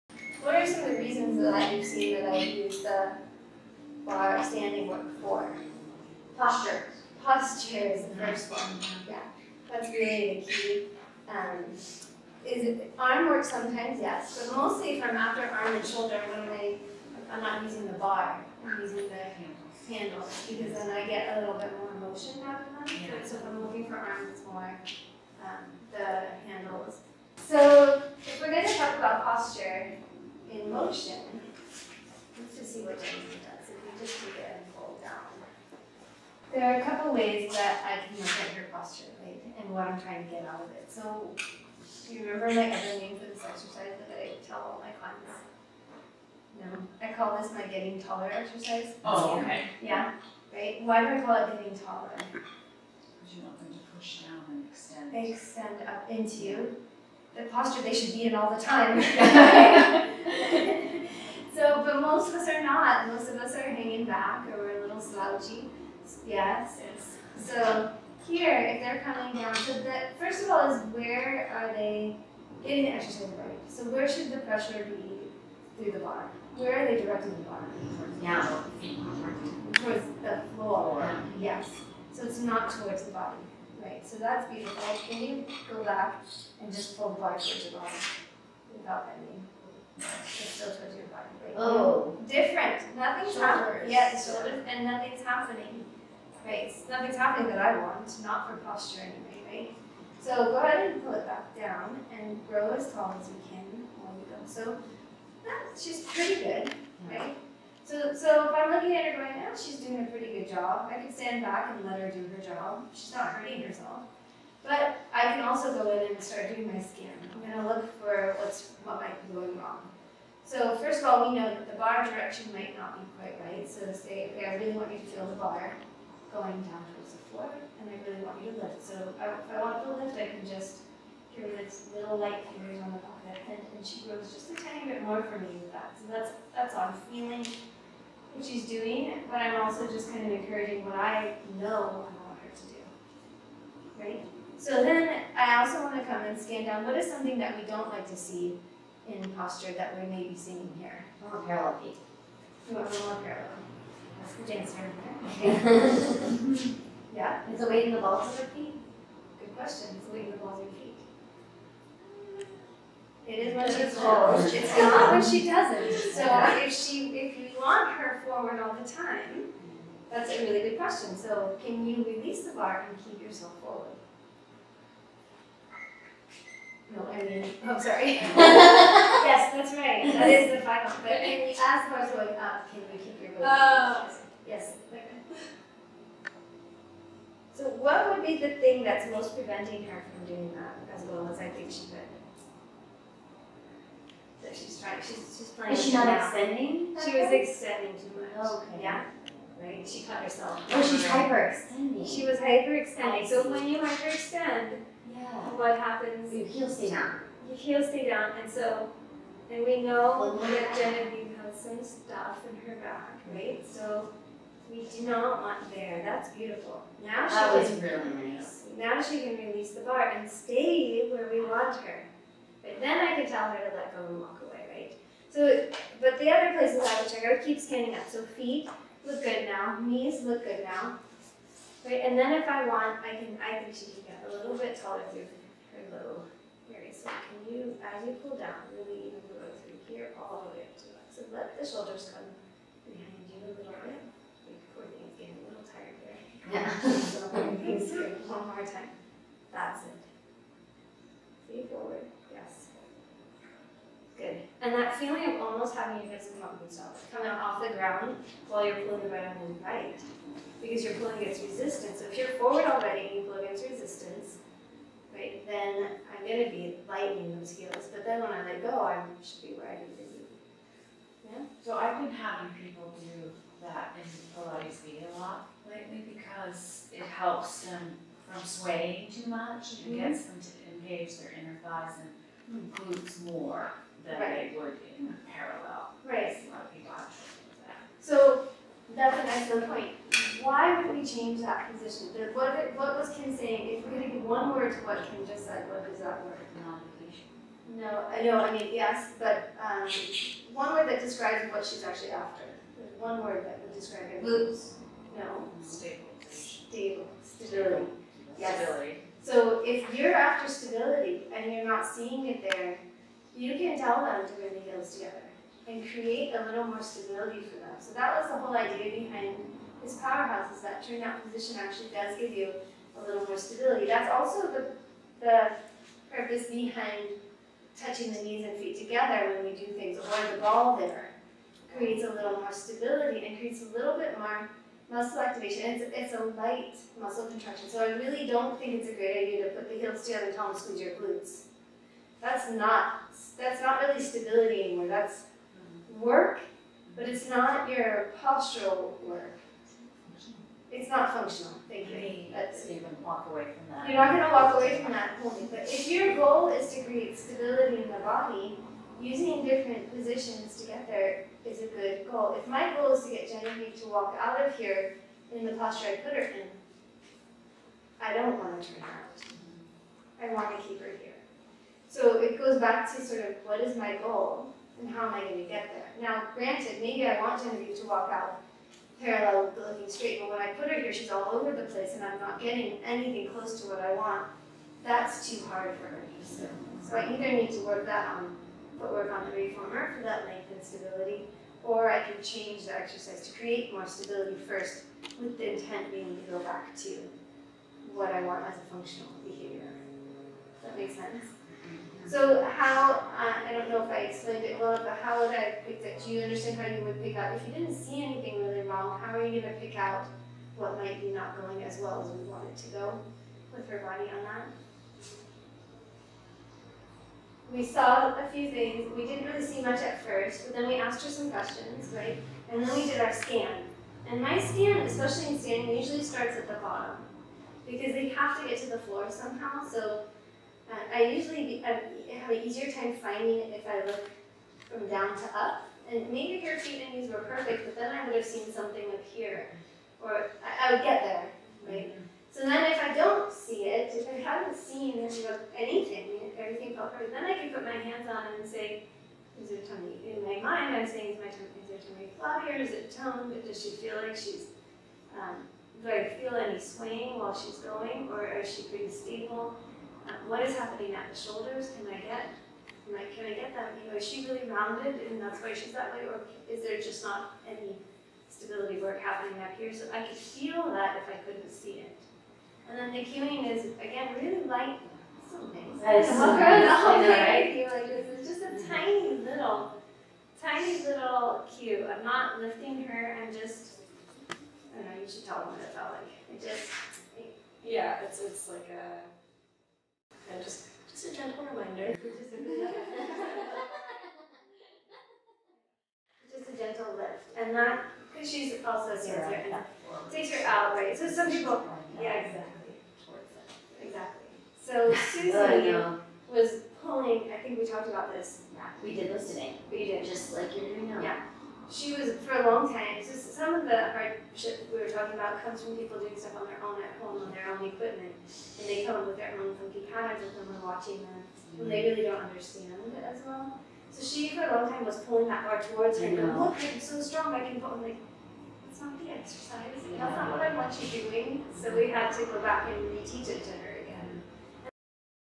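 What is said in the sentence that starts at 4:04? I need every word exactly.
things getting a little tired here.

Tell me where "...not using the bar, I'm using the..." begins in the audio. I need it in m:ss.
0:17.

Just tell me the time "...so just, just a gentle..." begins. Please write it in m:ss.
8:10.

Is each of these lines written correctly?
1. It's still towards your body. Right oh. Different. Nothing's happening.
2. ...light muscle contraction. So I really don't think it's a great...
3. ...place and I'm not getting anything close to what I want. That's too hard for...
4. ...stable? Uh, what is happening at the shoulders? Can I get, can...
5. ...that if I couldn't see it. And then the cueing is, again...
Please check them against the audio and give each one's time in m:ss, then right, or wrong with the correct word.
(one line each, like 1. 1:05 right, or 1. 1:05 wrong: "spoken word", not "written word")
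1. 1:29 right
2. 5:36 right
3. 6:21 right
4. 7:39 right
5. 7:50 right.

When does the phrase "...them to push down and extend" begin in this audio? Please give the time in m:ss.
0:53.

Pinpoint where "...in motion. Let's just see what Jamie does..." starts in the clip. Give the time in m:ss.
0:30.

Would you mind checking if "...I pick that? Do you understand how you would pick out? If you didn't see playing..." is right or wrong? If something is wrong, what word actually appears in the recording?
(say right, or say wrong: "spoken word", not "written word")
wrong: "anything", not "playing".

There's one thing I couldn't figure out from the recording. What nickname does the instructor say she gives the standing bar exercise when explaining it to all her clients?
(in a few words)
getting taller exercise.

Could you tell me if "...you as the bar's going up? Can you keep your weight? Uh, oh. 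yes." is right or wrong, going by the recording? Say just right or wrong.
right.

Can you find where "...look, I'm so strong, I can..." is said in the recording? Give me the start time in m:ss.
8:46.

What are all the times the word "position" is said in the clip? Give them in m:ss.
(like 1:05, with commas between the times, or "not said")
4:51, 5:21, 5:59.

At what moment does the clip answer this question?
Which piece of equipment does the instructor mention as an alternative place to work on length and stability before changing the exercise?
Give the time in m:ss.
6:29.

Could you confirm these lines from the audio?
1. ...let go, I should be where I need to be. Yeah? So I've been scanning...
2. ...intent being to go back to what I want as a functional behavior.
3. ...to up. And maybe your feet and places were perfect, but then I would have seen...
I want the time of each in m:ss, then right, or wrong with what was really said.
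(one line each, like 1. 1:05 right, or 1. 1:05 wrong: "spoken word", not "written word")
1. 4:28 wrong: "having", not "scanning"
2. 6:35 right
3. 7:15 wrong: "knees", not "places".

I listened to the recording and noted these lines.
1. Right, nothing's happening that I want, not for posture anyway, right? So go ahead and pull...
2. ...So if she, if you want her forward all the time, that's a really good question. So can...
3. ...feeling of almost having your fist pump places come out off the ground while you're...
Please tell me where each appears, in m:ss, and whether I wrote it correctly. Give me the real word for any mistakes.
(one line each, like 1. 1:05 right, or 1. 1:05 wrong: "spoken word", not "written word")
1. 1:36 right
2. 2:46 right
3. 4:14 wrong: "themselves", not "places".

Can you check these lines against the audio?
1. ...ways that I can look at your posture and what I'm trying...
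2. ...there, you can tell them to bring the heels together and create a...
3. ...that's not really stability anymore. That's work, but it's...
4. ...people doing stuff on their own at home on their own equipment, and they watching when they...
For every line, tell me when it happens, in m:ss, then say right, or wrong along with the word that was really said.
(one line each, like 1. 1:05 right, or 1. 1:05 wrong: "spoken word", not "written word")
1. 0:37 right
2. 5:12 right
3. 5:43 right
4. 8:35 right.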